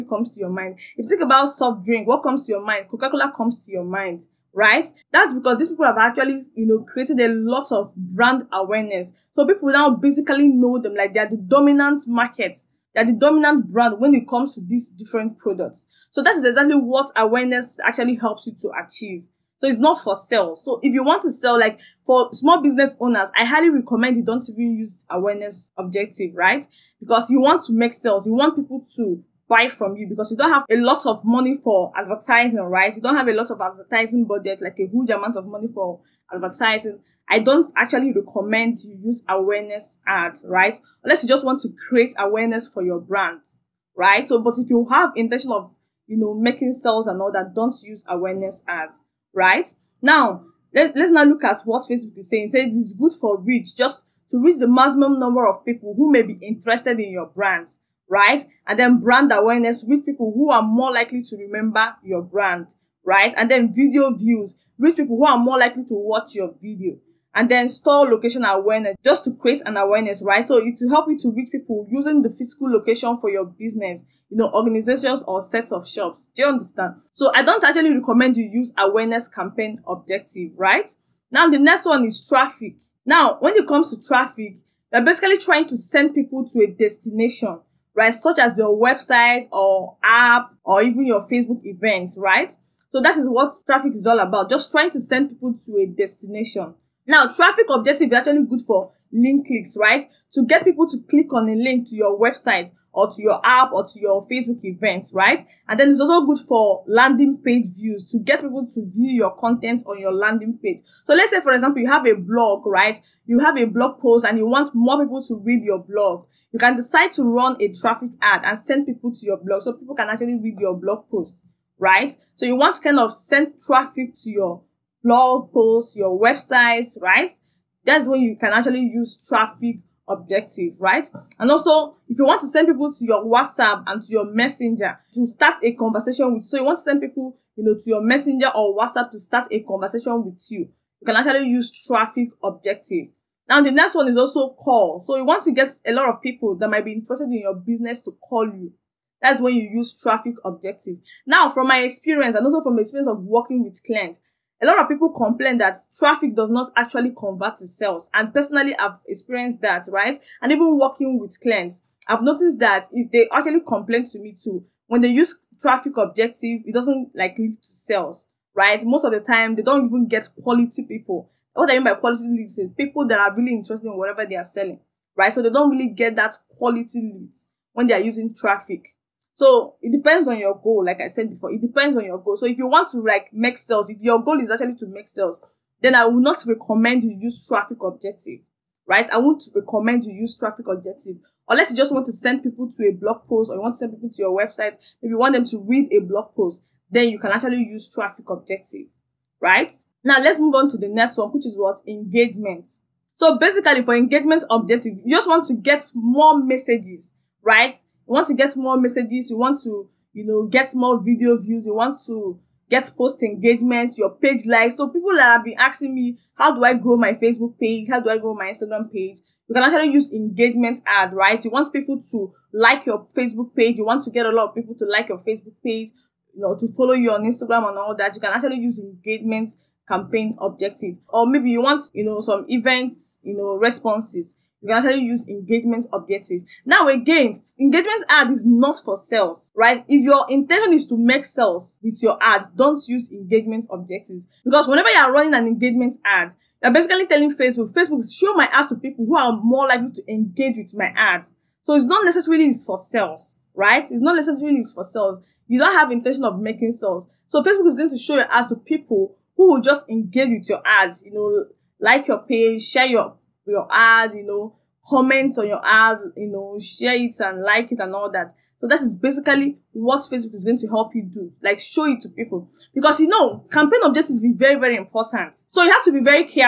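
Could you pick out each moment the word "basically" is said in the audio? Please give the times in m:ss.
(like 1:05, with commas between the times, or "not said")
0:09, 1:25, 3:23, 4:06, 4:28.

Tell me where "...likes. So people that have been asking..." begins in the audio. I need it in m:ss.
3:34.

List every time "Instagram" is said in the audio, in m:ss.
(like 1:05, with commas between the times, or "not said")
3:38, 3:47.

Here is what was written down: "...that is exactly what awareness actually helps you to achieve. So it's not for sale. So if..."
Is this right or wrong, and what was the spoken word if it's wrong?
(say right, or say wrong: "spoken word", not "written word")
right.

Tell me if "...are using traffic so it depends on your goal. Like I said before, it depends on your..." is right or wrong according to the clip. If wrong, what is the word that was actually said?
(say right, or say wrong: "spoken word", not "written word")
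right.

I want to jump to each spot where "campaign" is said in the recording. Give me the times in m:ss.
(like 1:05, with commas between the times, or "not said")
1:19, 3:49, 4:33.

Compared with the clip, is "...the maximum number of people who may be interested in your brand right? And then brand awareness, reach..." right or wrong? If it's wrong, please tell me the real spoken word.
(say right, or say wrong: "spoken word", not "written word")
right.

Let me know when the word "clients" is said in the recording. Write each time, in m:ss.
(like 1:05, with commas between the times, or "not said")
2:33, 2:41.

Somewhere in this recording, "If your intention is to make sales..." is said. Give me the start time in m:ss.
3:59.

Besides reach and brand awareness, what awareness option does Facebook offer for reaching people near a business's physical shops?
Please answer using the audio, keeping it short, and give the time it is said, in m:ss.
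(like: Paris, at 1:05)
Store location awareness, at 1:07.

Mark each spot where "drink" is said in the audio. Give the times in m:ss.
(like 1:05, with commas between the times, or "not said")
0:01.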